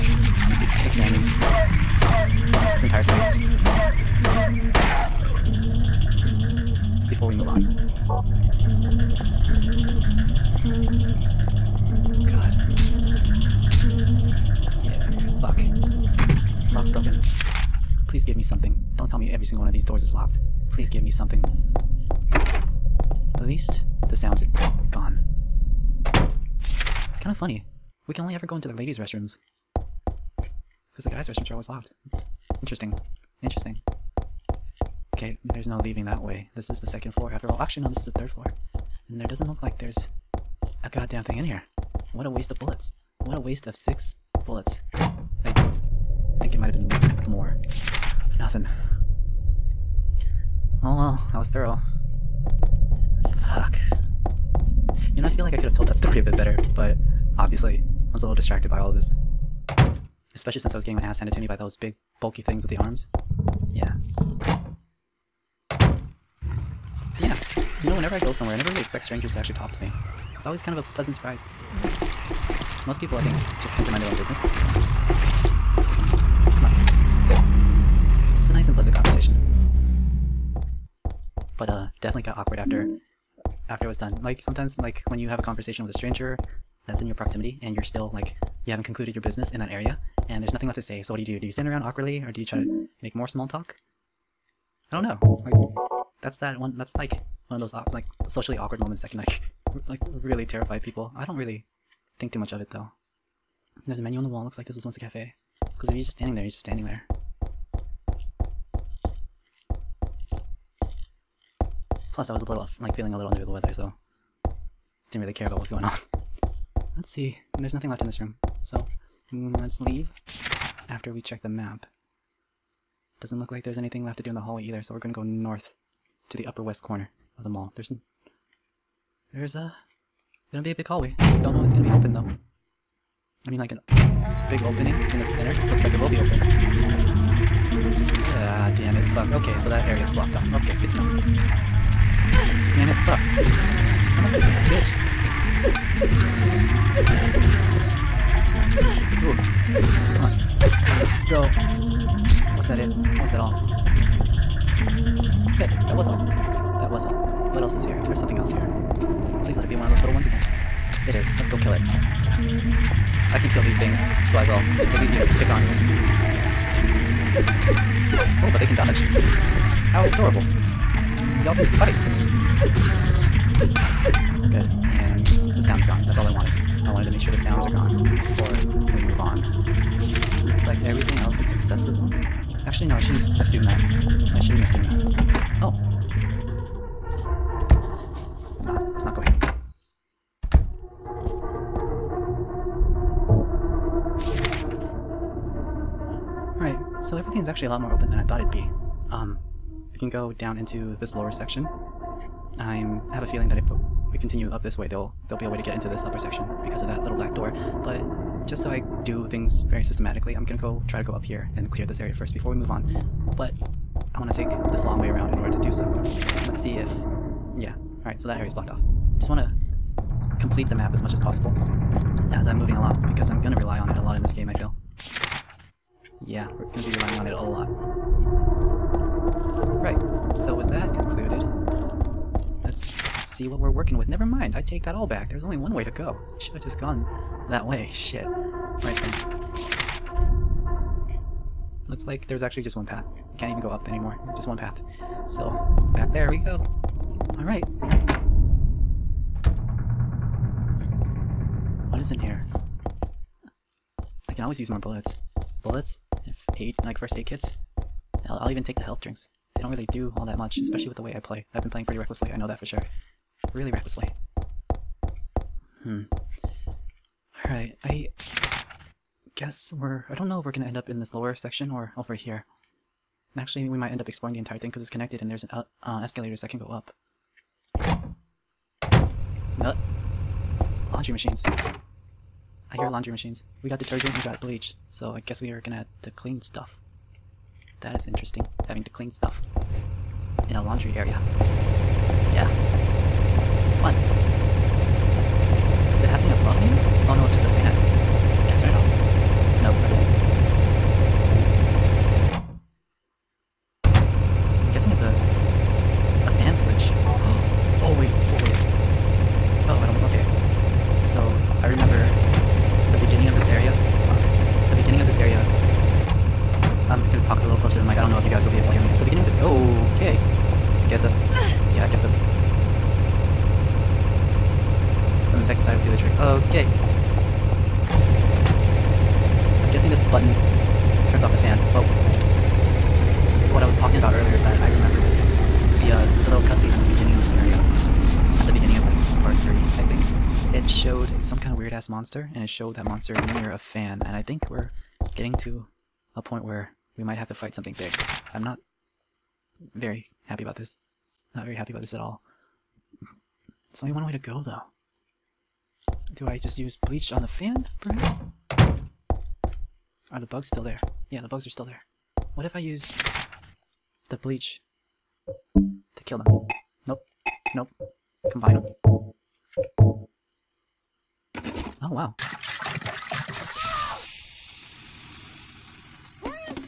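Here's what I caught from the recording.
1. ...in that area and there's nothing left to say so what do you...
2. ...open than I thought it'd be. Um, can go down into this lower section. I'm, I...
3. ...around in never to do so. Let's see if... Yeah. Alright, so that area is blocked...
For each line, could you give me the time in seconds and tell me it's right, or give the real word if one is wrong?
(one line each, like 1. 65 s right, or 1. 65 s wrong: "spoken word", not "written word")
1. 89 s right
2. 197 s right
3. 215 s wrong: "order", not "never".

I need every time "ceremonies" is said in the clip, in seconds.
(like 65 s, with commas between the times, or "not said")
not said.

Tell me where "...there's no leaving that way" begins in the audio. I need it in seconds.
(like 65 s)
35 s.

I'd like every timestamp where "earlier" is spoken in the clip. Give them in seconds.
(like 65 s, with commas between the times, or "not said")
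334 s.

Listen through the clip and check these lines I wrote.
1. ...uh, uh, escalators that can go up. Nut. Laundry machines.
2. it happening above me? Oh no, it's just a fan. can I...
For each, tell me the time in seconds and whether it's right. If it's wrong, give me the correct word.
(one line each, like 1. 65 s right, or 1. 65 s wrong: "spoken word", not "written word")
1. 275 s right
2. 296 s right.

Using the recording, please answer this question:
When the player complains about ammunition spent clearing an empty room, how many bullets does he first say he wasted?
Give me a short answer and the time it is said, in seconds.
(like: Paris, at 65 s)
6, at 43 s.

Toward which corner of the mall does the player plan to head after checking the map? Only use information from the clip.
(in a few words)
upper west corner.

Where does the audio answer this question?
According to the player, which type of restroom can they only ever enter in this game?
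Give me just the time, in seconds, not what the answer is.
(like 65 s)
28 s.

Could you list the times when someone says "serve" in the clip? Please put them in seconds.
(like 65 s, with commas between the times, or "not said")
not said.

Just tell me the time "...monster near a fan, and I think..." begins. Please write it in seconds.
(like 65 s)
342 s.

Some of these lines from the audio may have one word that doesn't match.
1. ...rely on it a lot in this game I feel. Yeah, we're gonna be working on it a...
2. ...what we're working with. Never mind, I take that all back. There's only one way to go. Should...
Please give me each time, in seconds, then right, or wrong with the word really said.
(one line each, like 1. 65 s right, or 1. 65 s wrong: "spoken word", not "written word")
1. 223 s wrong: "relying", not "working"
2. 233 s right.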